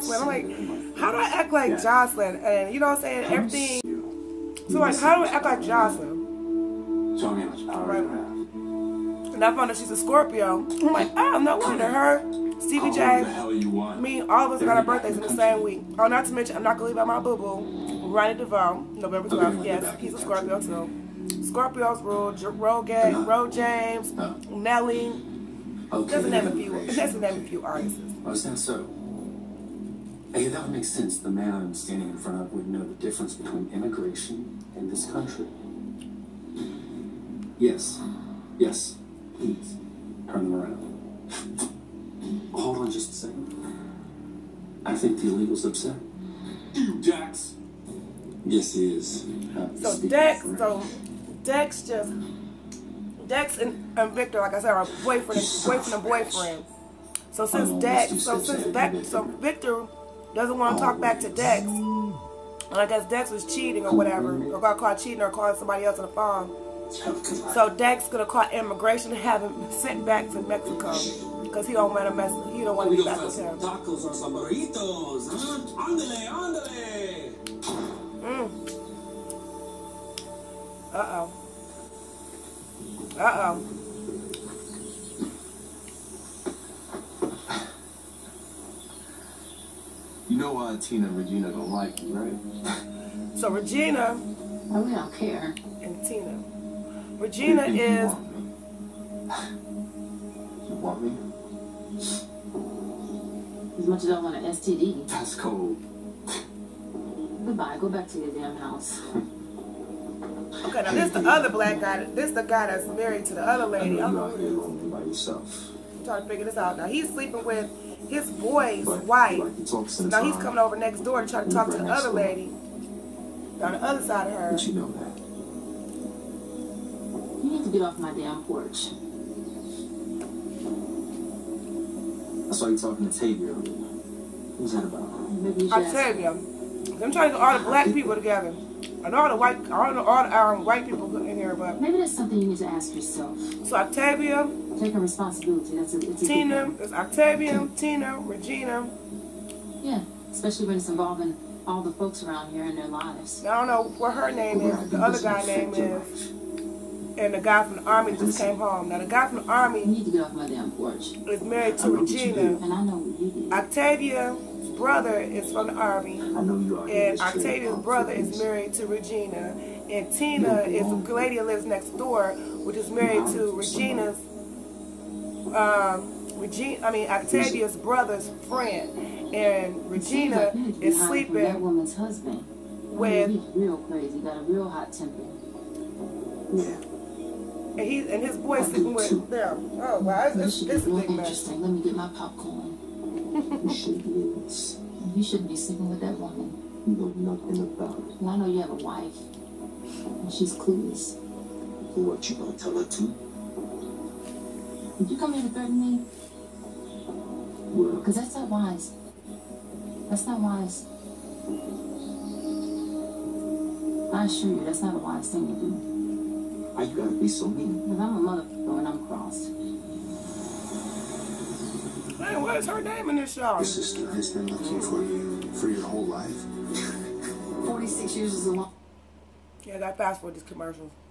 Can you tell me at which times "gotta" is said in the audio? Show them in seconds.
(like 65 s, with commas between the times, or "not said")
216 s.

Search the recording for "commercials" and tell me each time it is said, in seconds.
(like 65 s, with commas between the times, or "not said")
230 s.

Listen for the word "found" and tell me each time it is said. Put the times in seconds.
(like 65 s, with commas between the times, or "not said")
9 s.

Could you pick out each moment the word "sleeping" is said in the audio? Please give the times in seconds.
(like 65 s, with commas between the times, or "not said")
117 s, 181 s, 188 s, 195 s.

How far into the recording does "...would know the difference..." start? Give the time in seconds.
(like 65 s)
32 s.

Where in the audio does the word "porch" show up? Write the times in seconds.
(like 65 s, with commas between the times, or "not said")
128 s, 160 s.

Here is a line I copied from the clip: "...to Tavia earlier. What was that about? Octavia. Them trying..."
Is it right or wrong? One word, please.
right.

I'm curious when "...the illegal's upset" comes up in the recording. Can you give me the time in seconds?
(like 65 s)
45 s.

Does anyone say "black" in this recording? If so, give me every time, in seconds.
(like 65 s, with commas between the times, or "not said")
111 s, 137 s.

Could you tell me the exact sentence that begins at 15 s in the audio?
Oh, not to mention, I'm not gonna leave out my boo boo, Ronnie DeVoe, November 12th.